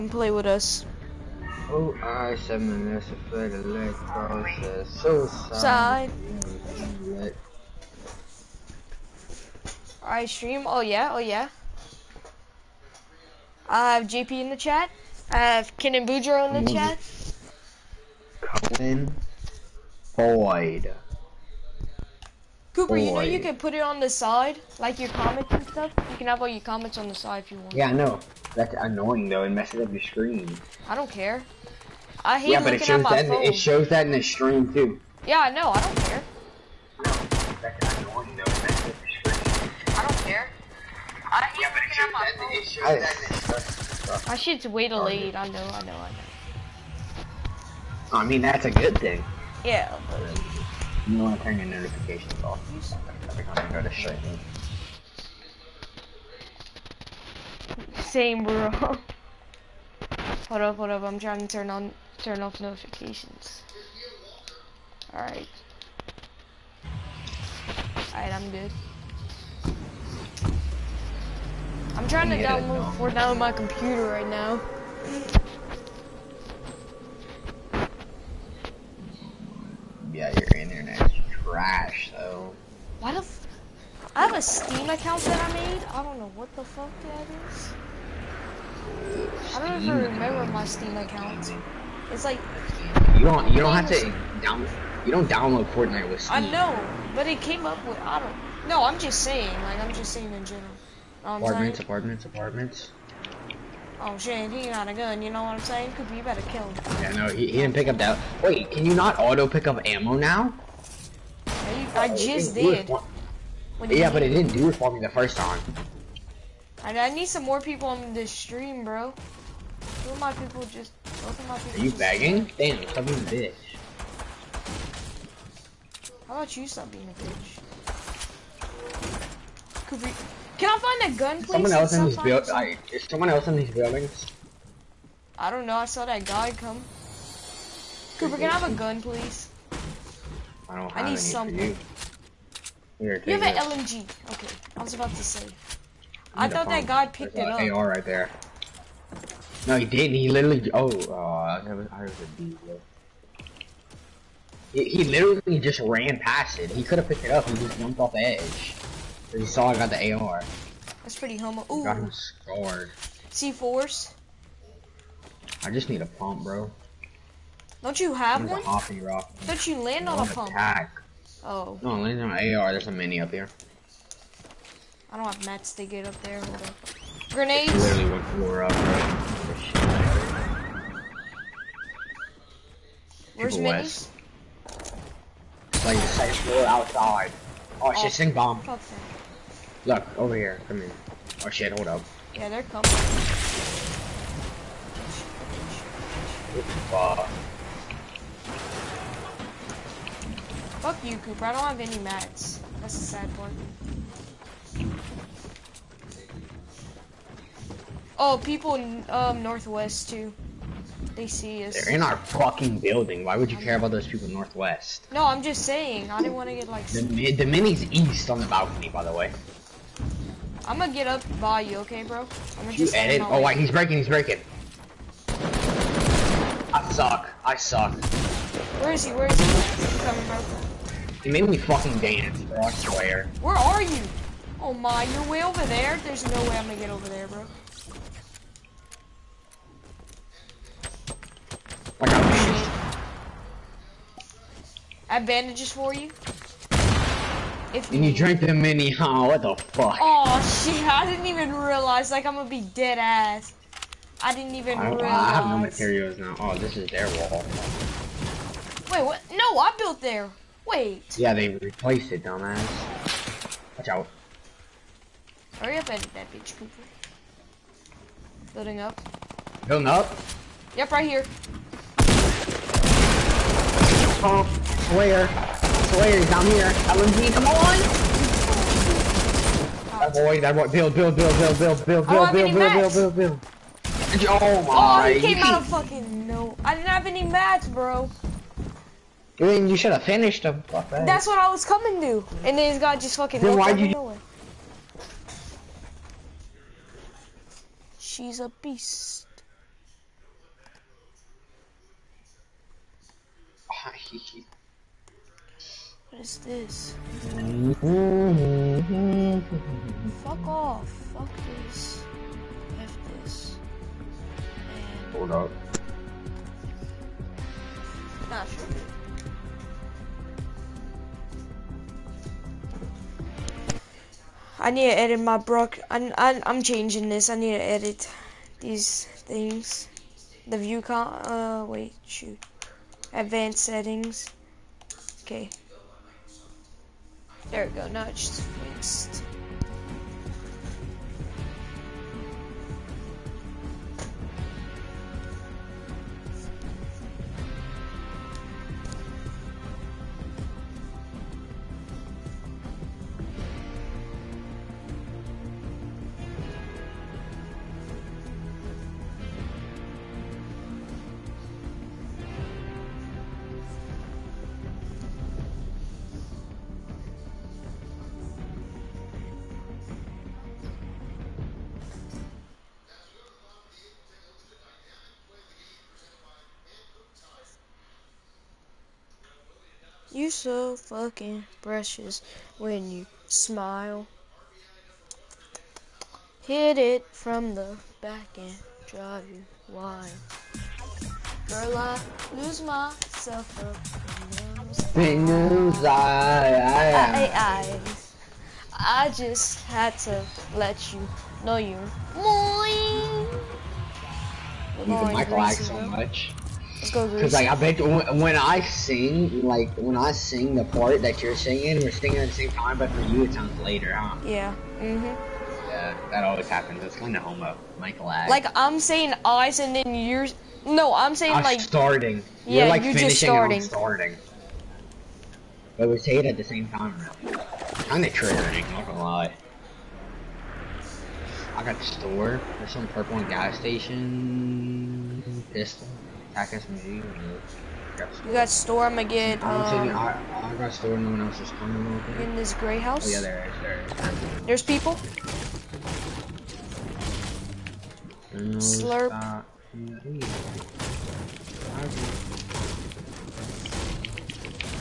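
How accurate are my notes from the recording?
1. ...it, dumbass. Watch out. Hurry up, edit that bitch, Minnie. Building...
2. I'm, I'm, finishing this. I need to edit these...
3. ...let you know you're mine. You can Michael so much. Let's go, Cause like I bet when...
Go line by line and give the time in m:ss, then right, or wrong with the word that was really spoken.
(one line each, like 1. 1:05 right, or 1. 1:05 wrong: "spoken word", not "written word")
1. 4:22 wrong: "Cooper", not "Minnie"
2. 5:25 wrong: "changing", not "finishing"
3. 6:40 right.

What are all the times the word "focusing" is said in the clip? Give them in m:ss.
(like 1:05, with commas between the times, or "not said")
not said.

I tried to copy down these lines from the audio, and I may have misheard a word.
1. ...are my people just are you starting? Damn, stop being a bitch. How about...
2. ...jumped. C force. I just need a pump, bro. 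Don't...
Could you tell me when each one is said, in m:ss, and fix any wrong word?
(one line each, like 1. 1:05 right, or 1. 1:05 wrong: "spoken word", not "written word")
1. 2:00 wrong: "bagging", not "starting"
2. 2:42 wrong: "scarred", not "jumped".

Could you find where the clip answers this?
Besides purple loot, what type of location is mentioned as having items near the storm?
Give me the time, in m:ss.
7:13.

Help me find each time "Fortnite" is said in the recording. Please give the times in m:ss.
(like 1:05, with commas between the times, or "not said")
1:12, 1:35.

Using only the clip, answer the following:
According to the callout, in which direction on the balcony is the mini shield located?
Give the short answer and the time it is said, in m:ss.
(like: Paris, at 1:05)
East, at 3:37.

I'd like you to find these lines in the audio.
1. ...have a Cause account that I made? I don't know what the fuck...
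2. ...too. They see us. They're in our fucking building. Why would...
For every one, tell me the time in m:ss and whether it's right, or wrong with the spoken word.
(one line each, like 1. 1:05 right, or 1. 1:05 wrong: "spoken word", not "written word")
1. 1:24 wrong: "Steam", not "Cause"
2. 3:30 right.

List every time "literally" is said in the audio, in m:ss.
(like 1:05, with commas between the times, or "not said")
2:30, 2:35, 2:57.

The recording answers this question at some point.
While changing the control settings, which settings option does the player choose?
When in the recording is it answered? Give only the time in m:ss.
5:33.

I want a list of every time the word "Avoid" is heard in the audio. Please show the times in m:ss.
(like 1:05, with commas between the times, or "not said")
4:40.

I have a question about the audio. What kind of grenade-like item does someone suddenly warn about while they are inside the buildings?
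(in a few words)
Stink bomb.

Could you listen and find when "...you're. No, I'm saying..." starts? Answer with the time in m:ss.
6:59.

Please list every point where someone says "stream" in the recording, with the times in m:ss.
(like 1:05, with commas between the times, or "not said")
0:10, 0:34, 0:43, 0:53, 1:58.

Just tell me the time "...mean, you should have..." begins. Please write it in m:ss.
4:49.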